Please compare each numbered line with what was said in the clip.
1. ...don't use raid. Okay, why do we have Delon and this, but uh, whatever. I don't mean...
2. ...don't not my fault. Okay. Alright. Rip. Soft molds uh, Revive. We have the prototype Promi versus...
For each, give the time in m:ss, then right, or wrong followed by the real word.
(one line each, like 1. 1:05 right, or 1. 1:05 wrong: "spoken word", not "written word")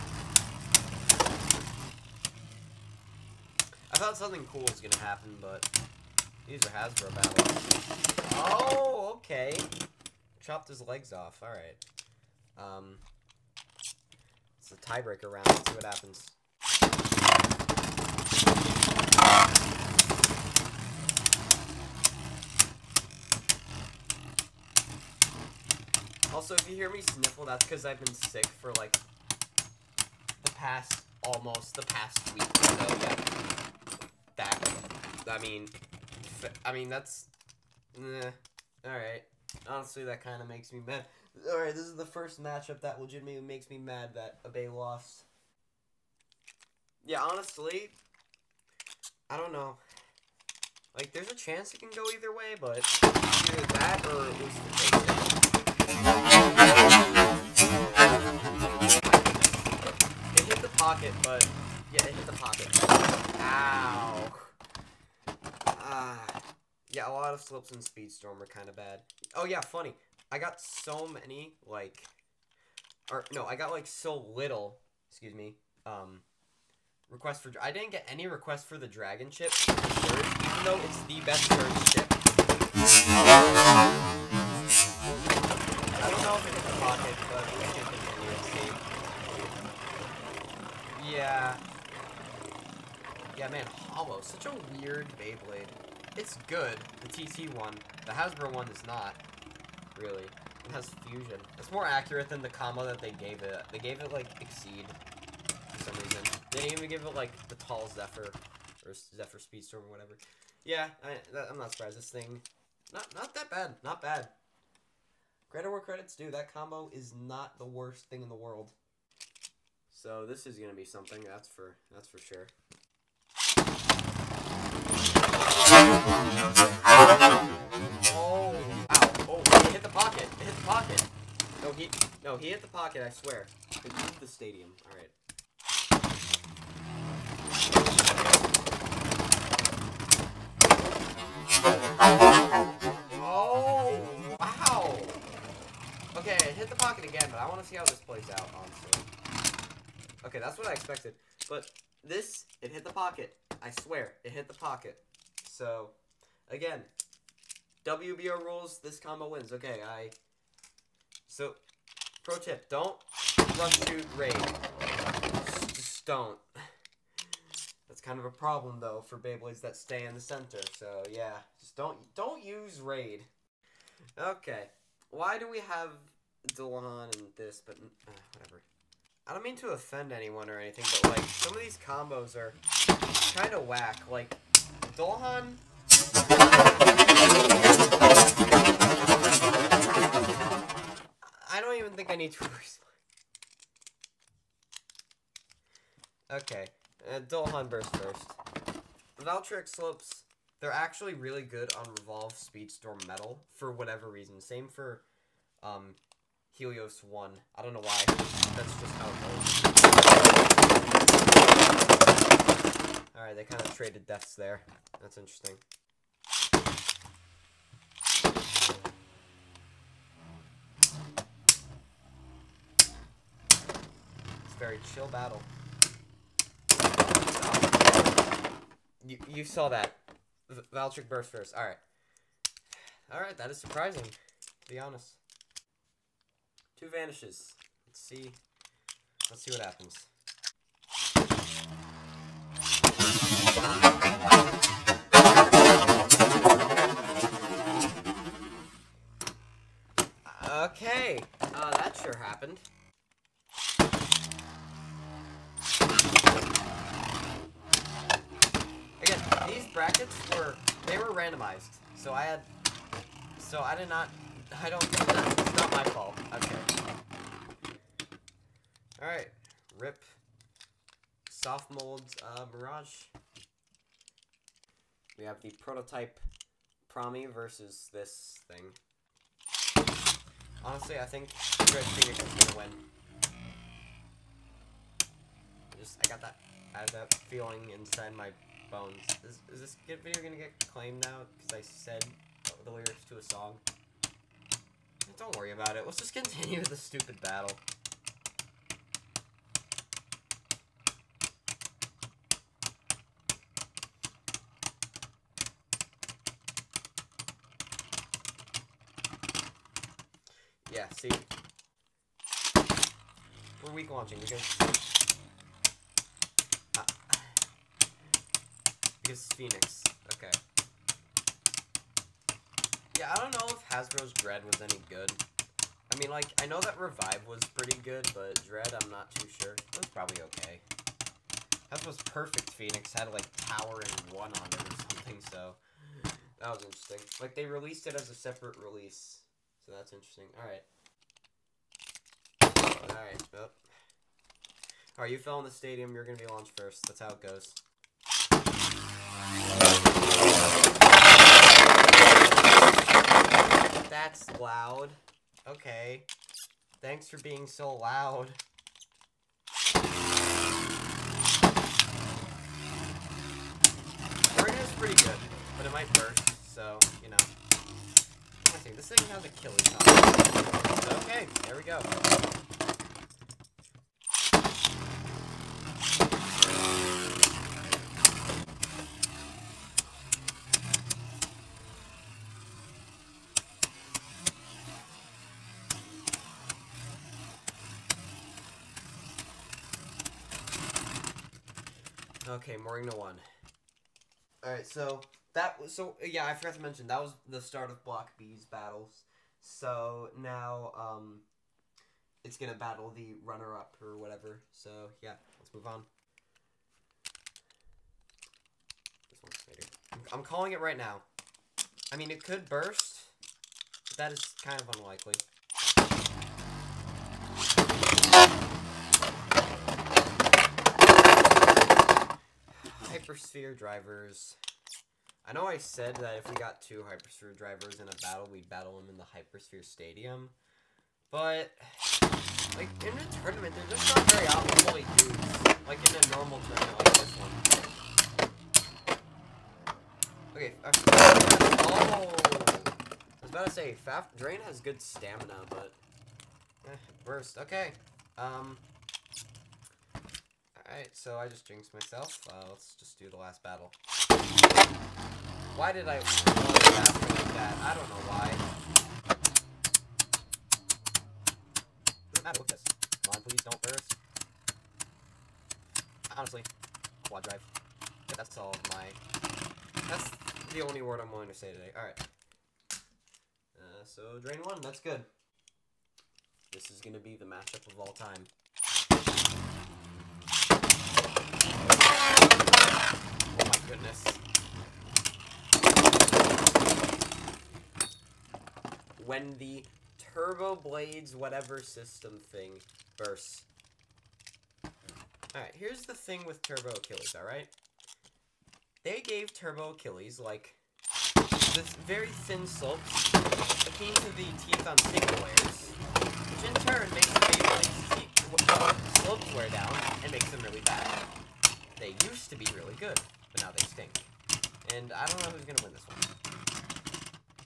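1. 2:52 right
2. 4:24 wrong: "Mirage", not "Revive".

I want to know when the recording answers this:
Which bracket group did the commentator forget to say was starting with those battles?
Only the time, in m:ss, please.
6:37.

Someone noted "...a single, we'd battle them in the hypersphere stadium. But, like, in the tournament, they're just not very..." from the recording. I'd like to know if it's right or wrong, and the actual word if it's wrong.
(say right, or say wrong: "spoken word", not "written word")
wrong: "battle", not "single".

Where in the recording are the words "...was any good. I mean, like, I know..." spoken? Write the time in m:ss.
5:24.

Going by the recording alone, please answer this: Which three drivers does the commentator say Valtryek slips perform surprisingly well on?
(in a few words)
Revolve, Speedstorm, Metal.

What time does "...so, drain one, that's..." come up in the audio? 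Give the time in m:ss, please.
7:53.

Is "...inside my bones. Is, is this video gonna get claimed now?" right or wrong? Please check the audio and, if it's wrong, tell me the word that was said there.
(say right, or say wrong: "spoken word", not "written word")
right.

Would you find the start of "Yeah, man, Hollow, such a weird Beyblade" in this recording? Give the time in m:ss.
1:33.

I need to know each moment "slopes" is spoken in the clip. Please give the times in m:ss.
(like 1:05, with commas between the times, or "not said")
8:22, 8:29.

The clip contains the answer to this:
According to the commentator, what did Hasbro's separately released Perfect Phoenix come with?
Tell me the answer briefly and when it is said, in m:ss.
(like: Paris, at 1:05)
Tower and 1, at 5:33.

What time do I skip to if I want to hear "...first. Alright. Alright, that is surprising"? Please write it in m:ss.
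3:51.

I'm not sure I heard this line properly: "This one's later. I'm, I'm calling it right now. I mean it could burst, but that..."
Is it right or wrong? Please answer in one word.
right.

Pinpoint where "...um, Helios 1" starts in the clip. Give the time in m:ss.
3:25.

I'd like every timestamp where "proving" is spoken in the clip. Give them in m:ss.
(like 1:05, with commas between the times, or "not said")
not said.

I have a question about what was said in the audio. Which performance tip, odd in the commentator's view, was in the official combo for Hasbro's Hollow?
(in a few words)
Exceed.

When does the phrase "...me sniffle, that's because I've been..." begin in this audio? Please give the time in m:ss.
0:26.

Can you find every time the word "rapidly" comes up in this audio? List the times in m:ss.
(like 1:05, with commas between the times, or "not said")
not said.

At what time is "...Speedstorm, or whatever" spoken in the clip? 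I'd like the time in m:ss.
1:49.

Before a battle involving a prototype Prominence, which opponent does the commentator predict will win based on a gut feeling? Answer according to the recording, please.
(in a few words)
Red Phoenix.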